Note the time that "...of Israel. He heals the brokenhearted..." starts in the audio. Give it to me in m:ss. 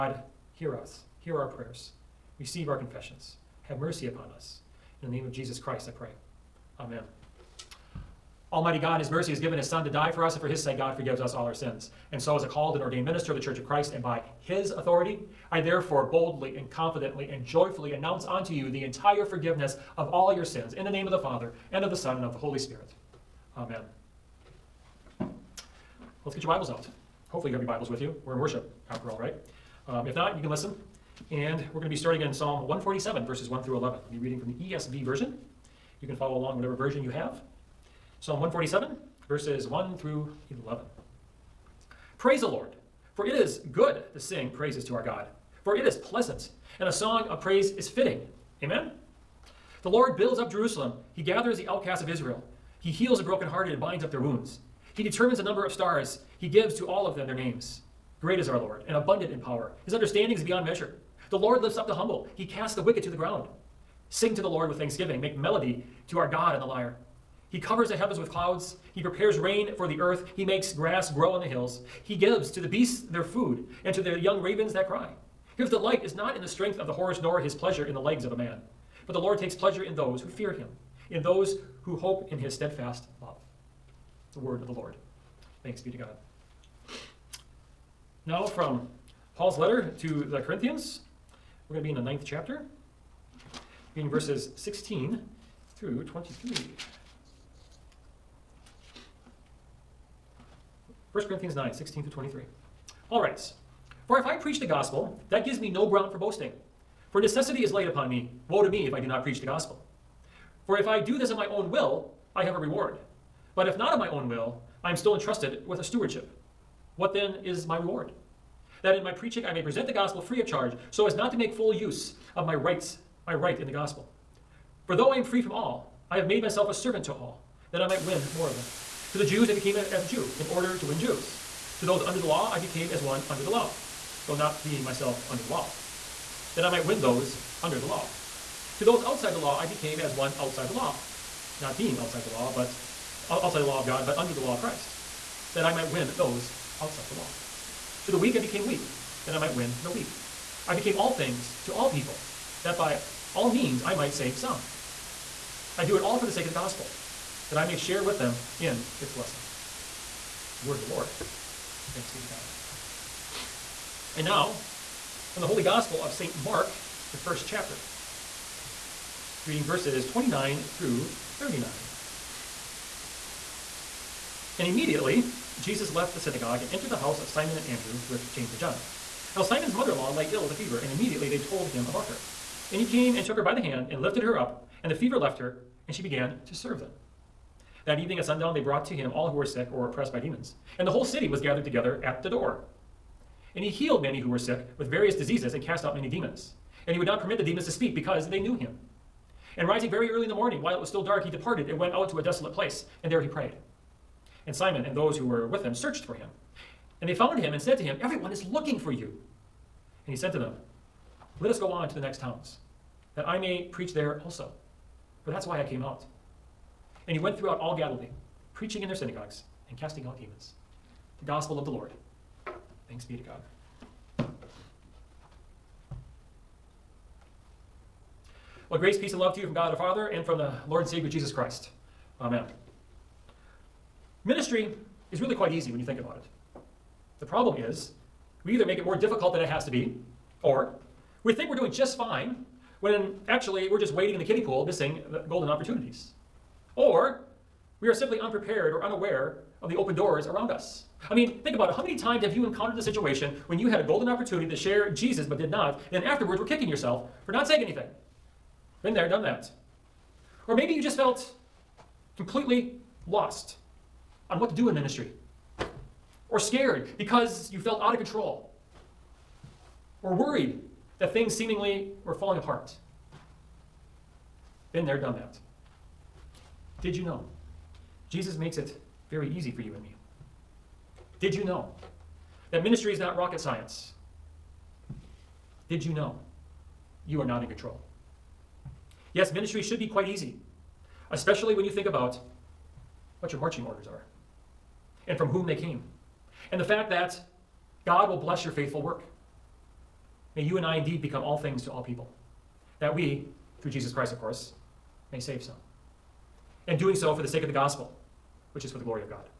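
0:52.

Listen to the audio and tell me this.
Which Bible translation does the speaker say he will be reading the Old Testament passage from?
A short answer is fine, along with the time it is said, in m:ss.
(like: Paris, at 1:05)
ESV, at 0:34.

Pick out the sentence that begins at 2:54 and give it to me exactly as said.
And immediately, Jesus left the synagogue and entered the house of Simon and Andrew with James and John.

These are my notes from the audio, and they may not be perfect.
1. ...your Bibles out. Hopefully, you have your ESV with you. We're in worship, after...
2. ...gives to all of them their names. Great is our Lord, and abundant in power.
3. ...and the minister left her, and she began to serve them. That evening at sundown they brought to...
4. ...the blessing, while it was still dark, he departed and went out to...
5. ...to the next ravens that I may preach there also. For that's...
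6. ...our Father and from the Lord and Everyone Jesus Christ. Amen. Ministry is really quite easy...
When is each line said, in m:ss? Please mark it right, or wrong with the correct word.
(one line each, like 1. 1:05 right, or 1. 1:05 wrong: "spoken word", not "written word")
1. 0:26 wrong: "Bibles", not "ESV"
2. 0:56 right
3. 3:04 wrong: "fever", not "minister"
4. 3:20 wrong: "morning", not "blessing"
5. 3:31 wrong: "towns", not "ravens"
6. 3:49 wrong: "Savior", not "Everyone".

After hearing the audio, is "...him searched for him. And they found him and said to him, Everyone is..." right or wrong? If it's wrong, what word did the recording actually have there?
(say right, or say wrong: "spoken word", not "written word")
right.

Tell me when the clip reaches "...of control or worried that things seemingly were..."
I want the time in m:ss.
4:27.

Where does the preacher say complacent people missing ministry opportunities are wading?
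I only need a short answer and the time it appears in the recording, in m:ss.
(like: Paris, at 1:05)
kiddie pool, at 4:04.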